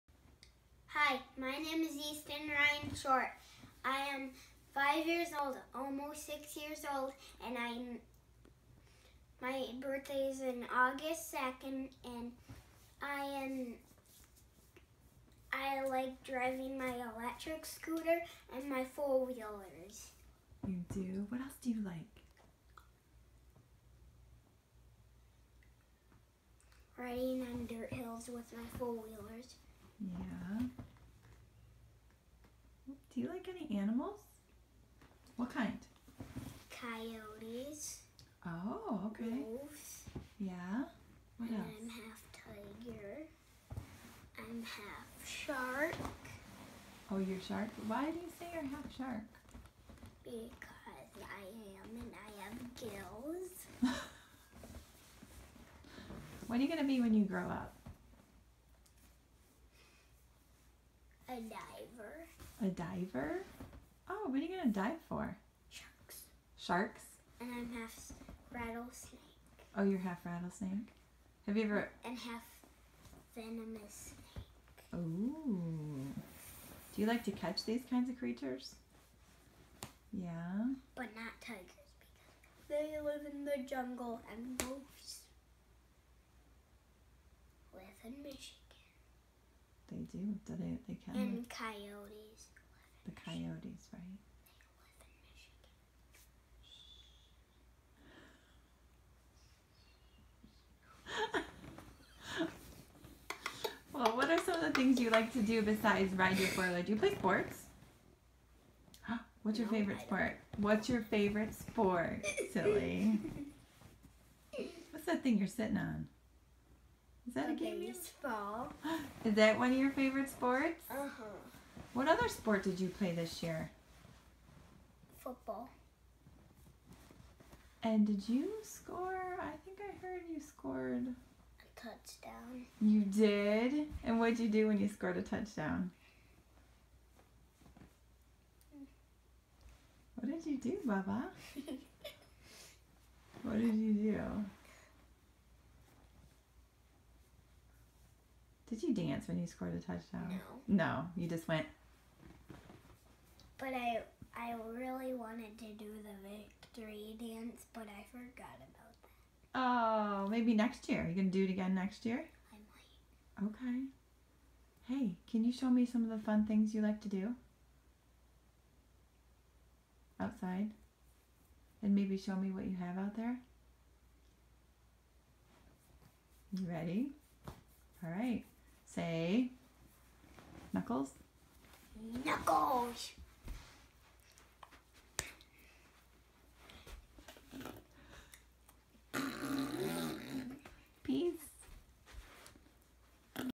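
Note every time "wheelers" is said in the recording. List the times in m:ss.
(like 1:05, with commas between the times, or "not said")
0:18, 0:28, 1:46.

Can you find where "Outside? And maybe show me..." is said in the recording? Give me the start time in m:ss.
2:50.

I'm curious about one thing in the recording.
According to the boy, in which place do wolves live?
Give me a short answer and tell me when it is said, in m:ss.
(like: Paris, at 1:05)
Michigan, at 1:28.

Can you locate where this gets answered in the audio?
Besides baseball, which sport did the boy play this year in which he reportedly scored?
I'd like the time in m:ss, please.
2:05.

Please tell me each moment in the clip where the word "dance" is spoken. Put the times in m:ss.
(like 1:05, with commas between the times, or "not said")
2:28, 2:37.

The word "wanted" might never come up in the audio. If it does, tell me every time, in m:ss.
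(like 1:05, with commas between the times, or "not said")
2:35.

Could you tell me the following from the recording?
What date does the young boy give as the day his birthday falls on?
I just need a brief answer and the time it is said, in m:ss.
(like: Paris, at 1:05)
August 2nd, at 0:10.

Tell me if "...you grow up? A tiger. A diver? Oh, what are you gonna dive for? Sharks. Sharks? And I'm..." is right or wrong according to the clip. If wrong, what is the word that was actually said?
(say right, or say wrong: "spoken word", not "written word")
wrong: "diver", not "tiger".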